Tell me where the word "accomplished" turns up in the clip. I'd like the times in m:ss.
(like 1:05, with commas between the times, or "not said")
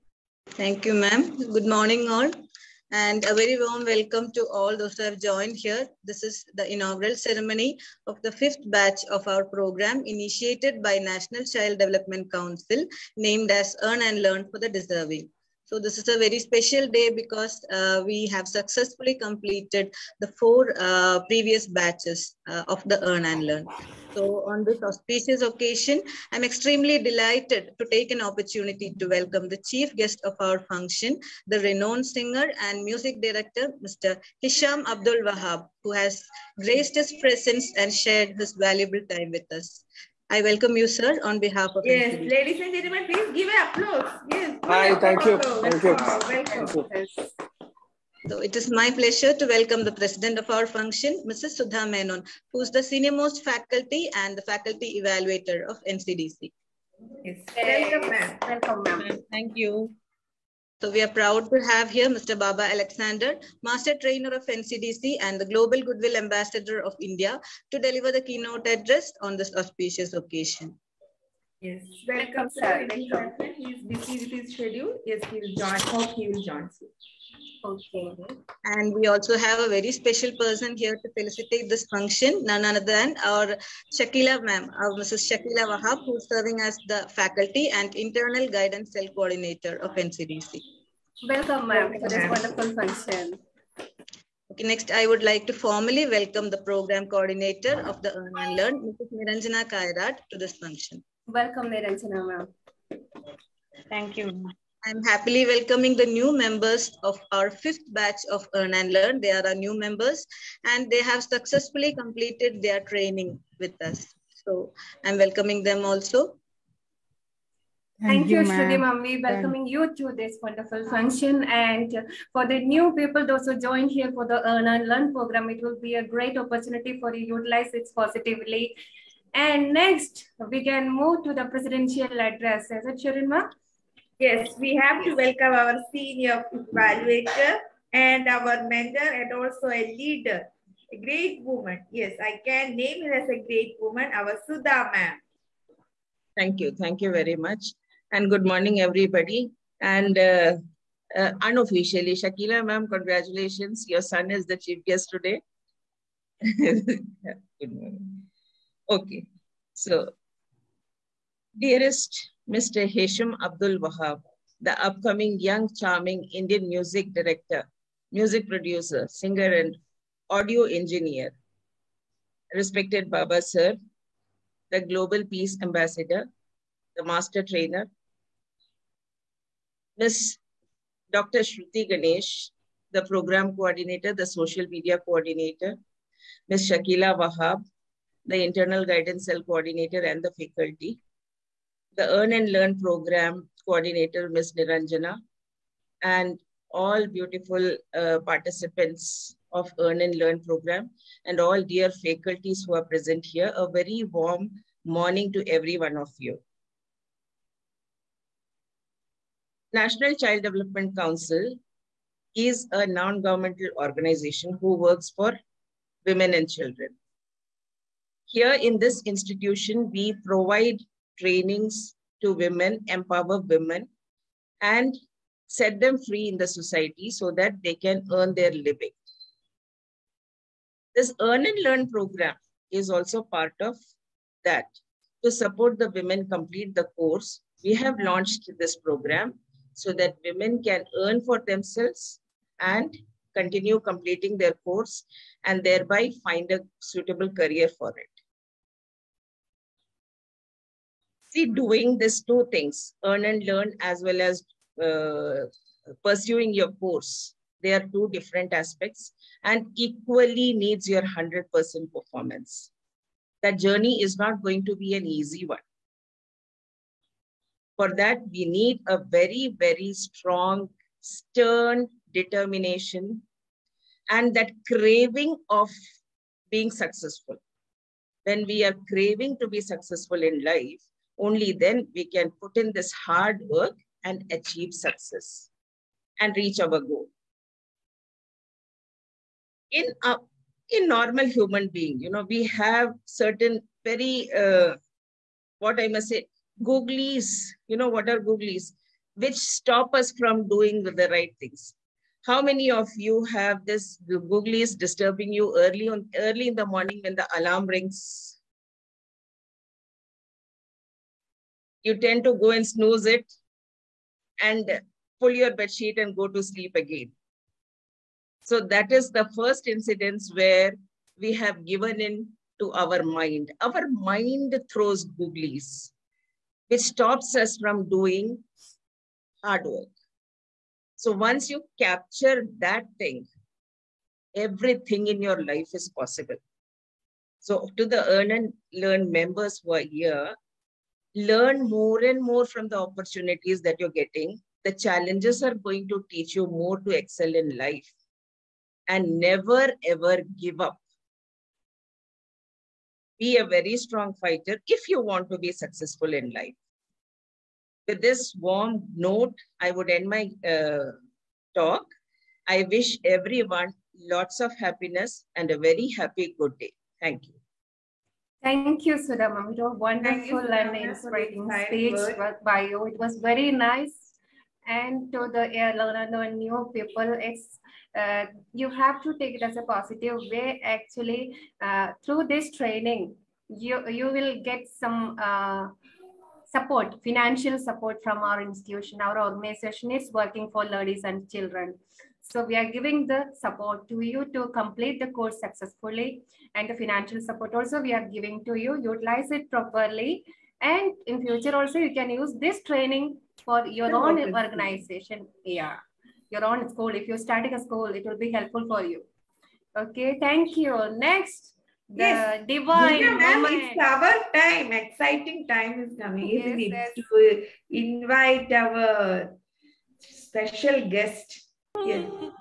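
not said.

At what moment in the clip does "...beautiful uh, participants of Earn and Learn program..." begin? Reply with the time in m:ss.
3:17.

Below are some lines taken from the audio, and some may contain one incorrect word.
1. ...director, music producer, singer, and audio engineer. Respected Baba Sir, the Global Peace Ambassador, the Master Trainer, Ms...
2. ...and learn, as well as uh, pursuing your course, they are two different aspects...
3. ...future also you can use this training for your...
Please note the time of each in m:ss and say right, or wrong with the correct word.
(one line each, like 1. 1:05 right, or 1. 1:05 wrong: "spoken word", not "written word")
1. 2:47 right
2. 4:13 right
3. 6:41 right.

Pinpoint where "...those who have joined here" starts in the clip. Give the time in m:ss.
0:04.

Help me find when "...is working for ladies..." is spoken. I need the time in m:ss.
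6:29.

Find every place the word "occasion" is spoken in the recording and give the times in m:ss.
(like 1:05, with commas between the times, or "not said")
0:25, 1:10.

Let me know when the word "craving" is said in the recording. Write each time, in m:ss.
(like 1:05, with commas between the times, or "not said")
4:34, 4:38.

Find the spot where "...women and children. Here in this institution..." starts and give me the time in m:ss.
3:36.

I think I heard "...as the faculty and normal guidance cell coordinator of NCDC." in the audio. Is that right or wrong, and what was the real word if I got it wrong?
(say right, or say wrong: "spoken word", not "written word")
wrong: "internal", not "normal".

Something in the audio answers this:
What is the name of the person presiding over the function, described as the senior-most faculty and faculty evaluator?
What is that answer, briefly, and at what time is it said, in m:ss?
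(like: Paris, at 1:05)
Sudha Menon, at 0:51.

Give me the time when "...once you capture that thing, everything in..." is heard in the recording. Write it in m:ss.
5:31.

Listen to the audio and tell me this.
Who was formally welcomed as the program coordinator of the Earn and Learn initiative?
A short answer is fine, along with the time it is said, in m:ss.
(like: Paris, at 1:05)
Niranjana Kairat, at 1:39.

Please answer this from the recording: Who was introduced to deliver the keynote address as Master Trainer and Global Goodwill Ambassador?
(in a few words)
Baba Alexander.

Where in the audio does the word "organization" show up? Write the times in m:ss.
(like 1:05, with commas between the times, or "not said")
3:33, 6:29, 6:44.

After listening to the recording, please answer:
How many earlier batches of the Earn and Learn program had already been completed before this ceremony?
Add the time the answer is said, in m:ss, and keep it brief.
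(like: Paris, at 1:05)
4, at 0:20.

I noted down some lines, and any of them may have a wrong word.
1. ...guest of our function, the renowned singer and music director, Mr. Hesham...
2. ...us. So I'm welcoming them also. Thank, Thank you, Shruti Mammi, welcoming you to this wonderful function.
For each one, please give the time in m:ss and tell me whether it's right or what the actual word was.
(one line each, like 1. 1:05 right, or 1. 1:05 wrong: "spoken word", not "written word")
1. 0:29 right
2. 1:53 right.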